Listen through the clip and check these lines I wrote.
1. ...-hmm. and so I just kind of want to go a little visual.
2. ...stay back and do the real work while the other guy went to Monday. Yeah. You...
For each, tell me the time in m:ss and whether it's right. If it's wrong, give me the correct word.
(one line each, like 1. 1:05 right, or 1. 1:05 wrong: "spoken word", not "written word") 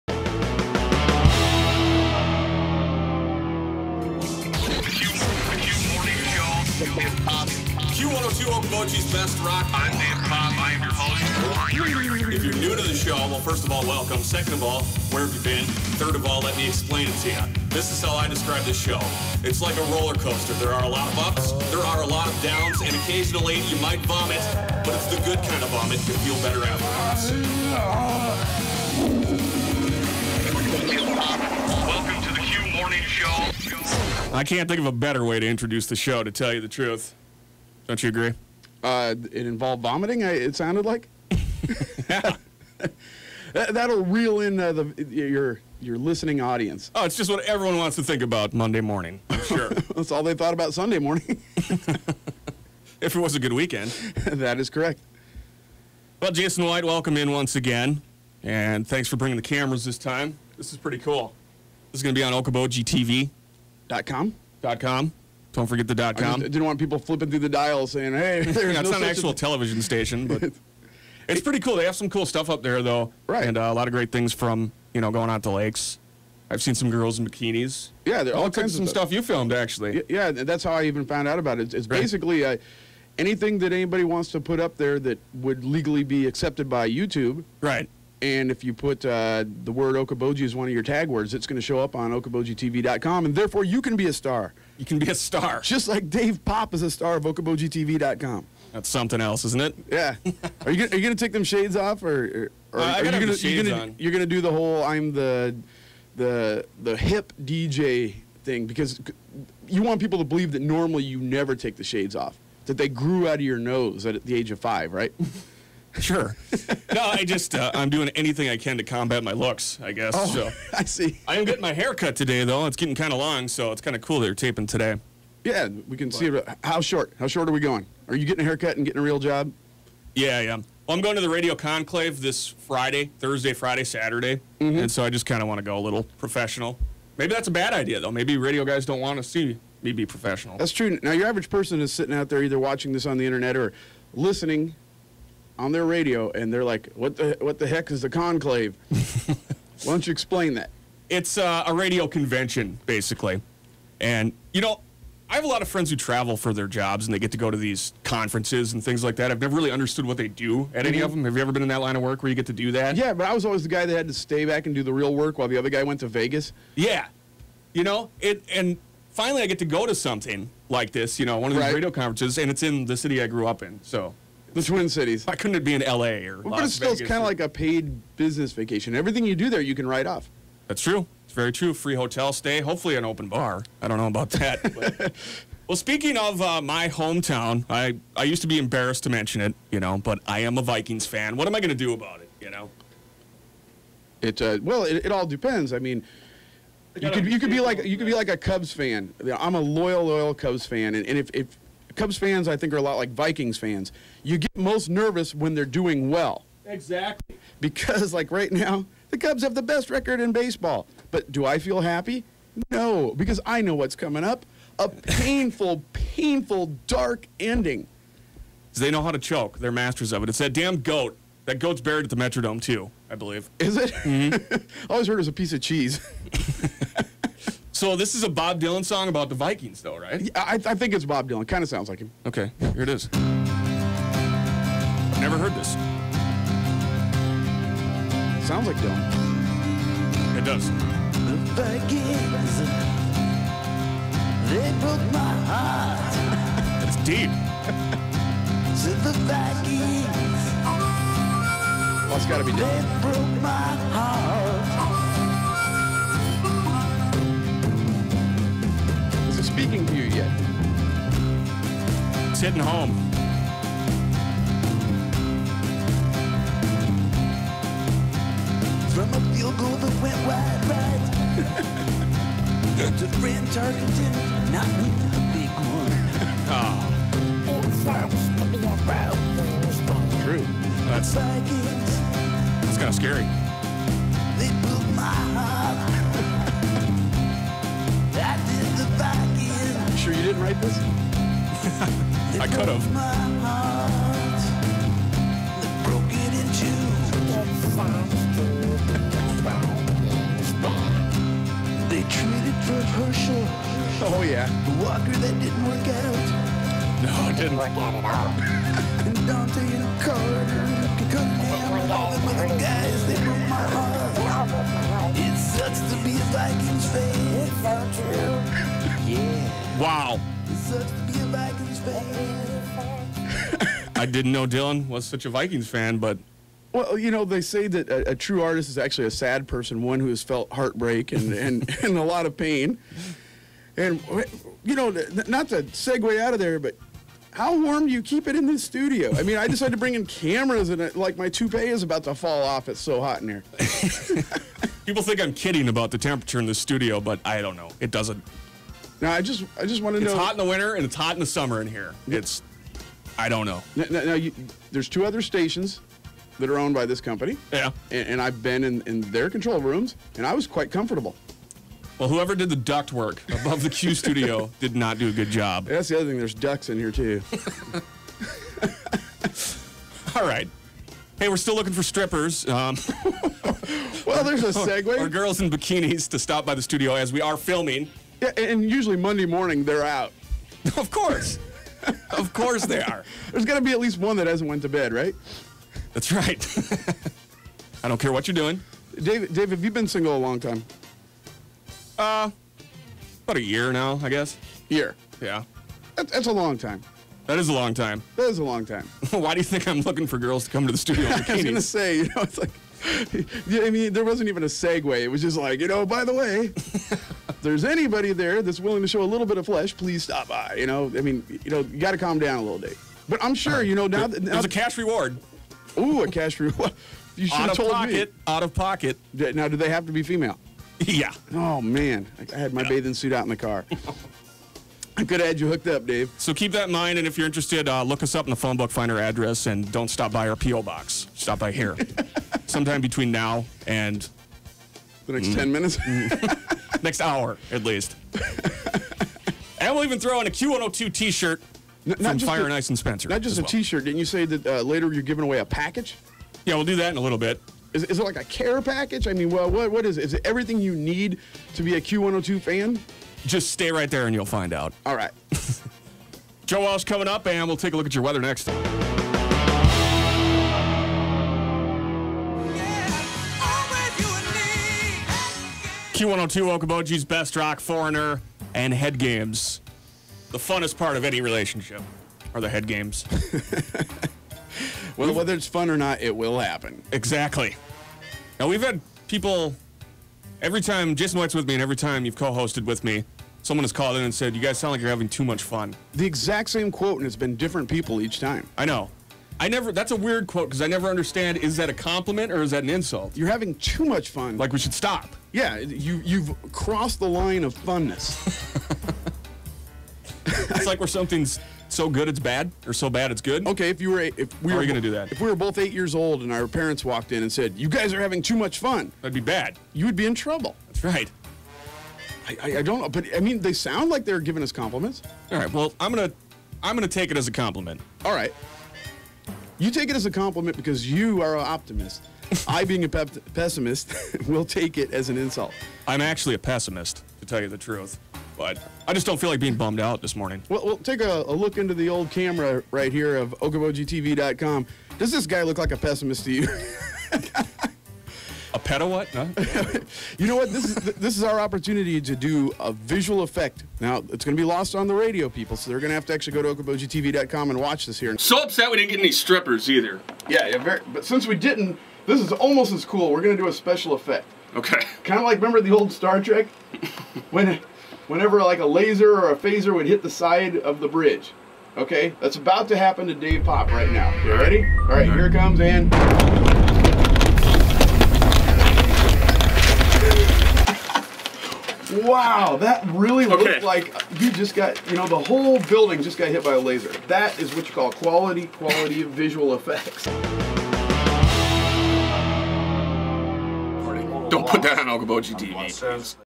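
1. 2:14 wrong: "professional", not "visual"
2. 2:44 wrong: "Vegas", not "Monday".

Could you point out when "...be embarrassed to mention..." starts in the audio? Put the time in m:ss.
3:08.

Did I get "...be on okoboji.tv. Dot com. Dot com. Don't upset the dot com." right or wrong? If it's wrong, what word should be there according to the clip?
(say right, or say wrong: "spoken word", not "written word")
wrong: "forget", not "upset".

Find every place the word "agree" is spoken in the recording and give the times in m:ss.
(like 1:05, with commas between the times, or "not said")
0:38.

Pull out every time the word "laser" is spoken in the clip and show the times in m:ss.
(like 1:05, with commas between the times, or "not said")
9:18, 9:36.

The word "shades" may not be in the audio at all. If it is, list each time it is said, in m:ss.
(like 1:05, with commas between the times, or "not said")
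1:41, 1:51.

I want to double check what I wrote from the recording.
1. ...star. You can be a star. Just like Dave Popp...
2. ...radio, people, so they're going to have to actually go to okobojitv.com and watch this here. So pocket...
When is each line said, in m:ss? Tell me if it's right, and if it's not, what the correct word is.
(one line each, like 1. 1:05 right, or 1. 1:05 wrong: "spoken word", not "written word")
1. 1:34 right
2. 9:04 wrong: "upset", not "pocket".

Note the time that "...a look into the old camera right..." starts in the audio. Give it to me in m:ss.
8:51.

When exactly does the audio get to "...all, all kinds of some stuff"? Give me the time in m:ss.
1:18.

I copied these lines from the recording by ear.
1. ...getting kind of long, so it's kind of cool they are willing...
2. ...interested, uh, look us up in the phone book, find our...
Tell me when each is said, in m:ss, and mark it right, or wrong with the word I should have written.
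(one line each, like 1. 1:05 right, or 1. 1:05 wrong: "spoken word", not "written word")
1. 2:02 wrong: "taping", not "willing"
2. 7:07 right.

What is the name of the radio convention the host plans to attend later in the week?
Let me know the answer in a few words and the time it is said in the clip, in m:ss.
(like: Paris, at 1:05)
Radio Conclave, at 2:11.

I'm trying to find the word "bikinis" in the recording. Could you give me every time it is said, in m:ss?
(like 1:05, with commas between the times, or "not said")
1:17, 6:15.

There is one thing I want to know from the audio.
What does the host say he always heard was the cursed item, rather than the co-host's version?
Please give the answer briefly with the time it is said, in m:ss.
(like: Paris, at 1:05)
a piece of cheese, at 3:45.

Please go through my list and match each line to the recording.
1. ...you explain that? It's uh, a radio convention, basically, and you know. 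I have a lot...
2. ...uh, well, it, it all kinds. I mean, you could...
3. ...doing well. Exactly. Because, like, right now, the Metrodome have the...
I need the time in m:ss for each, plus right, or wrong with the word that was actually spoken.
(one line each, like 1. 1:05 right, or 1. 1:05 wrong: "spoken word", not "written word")
1. 2:30 right
2. 3:14 wrong: "depends", not "kinds"
3. 3:25 wrong: "Cubs", not "Metrodome".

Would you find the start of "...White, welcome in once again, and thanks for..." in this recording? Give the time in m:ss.
0:56.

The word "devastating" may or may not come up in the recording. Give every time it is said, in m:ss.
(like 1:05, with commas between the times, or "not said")
not said.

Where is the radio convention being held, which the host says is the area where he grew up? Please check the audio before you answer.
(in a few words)
Twin Cities.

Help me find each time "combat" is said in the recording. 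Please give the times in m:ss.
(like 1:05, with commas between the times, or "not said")
1:58.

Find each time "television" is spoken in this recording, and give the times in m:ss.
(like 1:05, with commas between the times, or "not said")
1:09.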